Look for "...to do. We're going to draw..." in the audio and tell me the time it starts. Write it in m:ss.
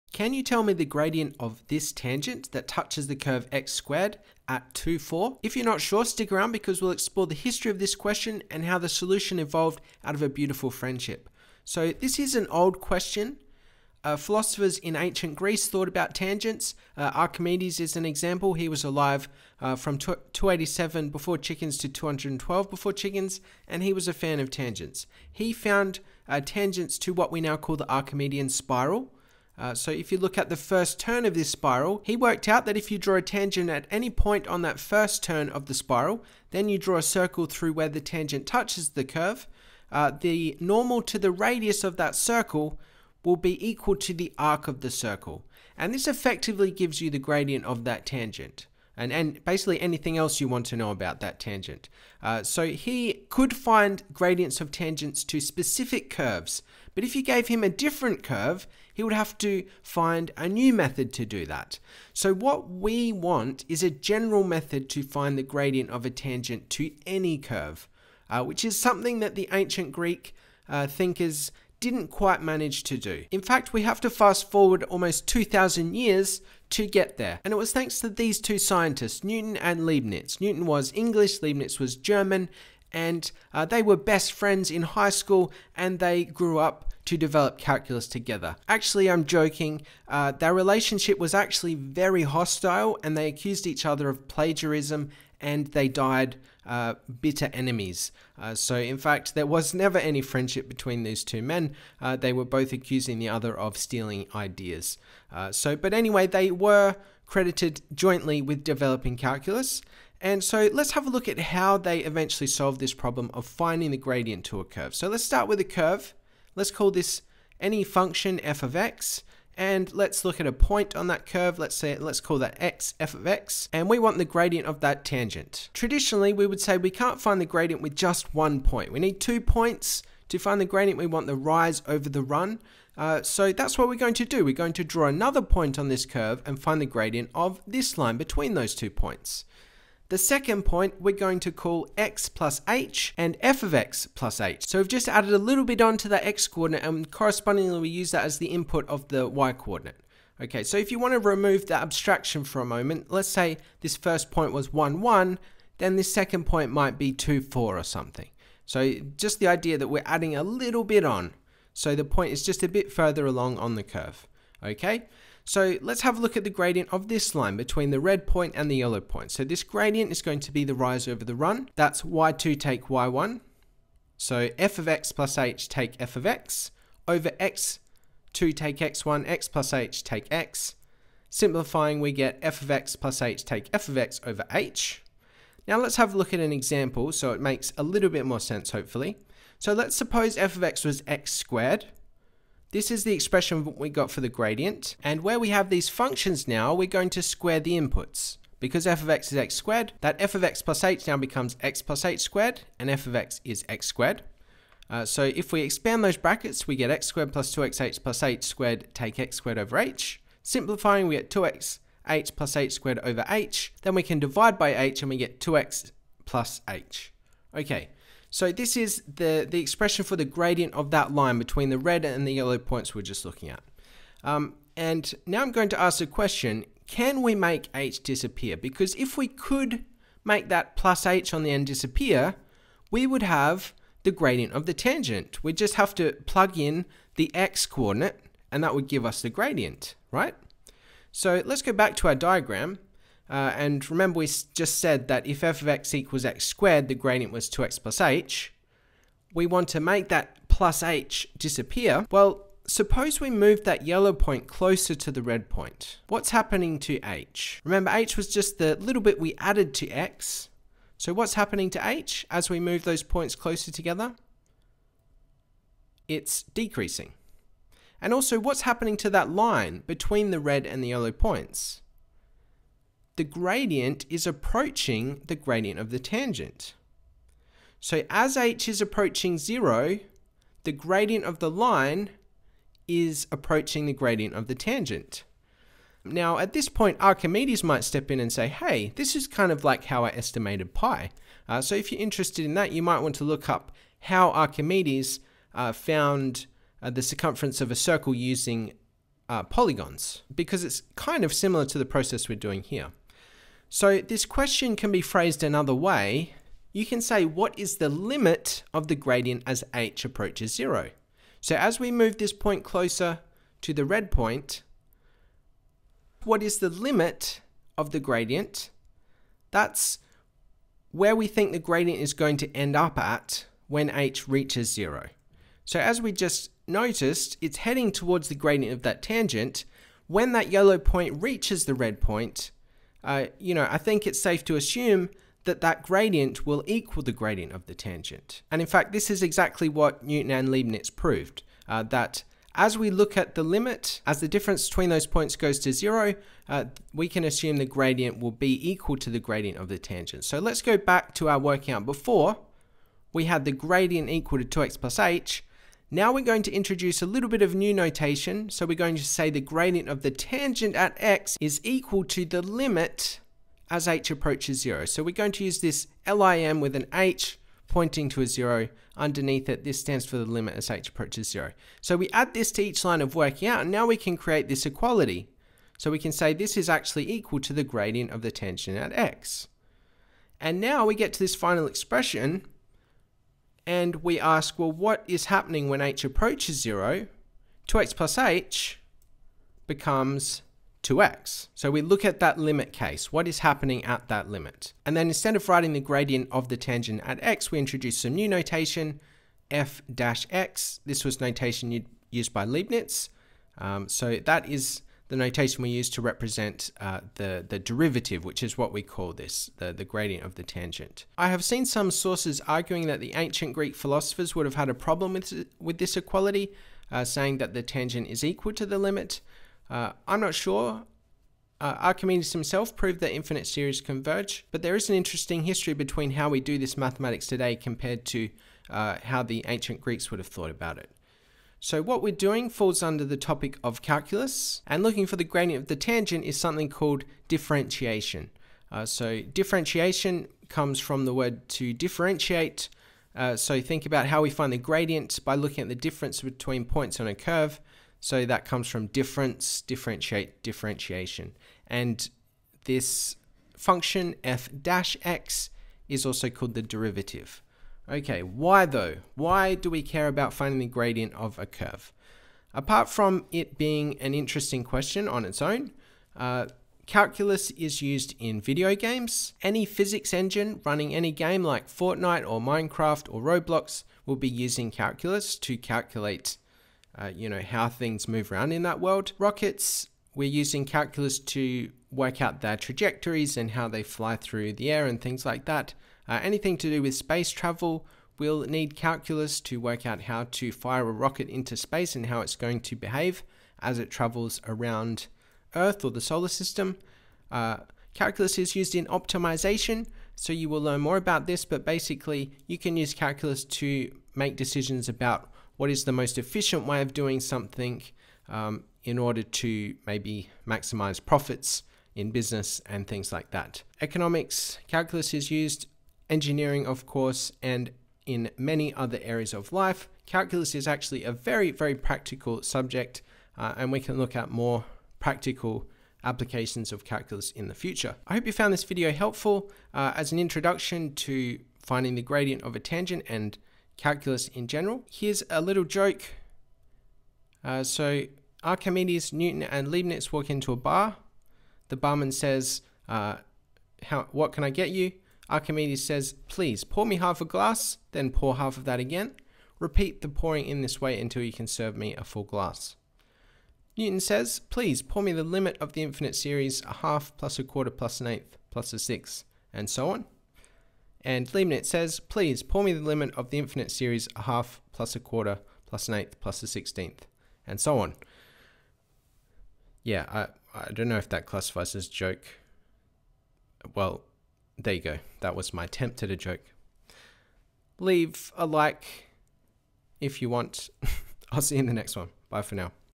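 2:14.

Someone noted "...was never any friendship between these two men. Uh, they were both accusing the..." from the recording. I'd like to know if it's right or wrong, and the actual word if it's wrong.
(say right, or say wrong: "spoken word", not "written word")
right.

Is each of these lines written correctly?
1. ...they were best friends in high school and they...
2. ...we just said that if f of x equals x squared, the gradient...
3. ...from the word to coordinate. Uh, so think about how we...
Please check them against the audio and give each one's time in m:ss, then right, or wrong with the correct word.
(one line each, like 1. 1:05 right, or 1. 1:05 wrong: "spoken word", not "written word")
1. 1:23 right
2. 4:04 right
3. 7:20 wrong: "differentiate", not "coordinate".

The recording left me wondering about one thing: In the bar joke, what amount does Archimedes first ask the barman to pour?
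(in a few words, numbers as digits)
half a glass.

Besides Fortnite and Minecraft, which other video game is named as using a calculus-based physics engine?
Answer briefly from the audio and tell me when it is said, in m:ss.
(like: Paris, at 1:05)
Roblox, at 7:53.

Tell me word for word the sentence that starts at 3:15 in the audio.
And where we have these functions now, we're going to square the inputs.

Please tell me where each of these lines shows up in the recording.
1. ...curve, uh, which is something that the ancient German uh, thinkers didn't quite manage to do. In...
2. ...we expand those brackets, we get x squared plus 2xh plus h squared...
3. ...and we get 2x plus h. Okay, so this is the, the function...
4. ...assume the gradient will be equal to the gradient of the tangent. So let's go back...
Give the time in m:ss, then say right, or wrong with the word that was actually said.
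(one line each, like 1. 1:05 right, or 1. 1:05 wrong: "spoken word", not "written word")
1. 1:07 wrong: "Greek", not "German"
2. 3:25 right
3. 3:35 wrong: "expression", not "function"
4. 5:47 right.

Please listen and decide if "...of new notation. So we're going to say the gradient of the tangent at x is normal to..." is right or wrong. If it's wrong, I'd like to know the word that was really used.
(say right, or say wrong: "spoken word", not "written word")
wrong: "equal", not "normal".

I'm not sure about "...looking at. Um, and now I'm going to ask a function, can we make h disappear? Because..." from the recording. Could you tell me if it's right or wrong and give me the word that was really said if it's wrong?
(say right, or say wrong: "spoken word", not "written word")
wrong: "question", not "function".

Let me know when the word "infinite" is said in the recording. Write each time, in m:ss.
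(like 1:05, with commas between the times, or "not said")
7:03, 9:15, 9:23.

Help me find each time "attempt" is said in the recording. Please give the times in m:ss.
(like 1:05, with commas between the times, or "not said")
9:35.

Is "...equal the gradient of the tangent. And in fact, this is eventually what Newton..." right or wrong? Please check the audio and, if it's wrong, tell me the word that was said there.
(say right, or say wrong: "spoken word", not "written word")
wrong: "exactly", not "eventually".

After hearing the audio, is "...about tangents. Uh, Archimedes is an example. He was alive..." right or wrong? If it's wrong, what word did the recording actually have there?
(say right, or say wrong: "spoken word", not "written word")
right.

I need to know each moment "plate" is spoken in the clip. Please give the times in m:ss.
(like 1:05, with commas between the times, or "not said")
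not said.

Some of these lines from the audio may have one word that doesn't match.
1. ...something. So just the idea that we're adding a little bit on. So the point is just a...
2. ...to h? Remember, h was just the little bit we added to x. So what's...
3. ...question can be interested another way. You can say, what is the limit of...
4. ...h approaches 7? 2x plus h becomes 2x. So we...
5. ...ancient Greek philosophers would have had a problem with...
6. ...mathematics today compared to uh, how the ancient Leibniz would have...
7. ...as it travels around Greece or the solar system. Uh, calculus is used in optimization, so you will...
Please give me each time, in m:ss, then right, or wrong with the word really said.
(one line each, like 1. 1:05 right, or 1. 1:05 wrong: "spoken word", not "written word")
1. 2:37 right
2. 4:16 right
3. 5:04 wrong: "phrased", not "interested"
4. 6:25 wrong: "0", not "7"
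5. 6:53 right
6. 7:06 wrong: "Greeks", not "Leibniz"
7. 8:13 wrong: "Earth", not "Greece".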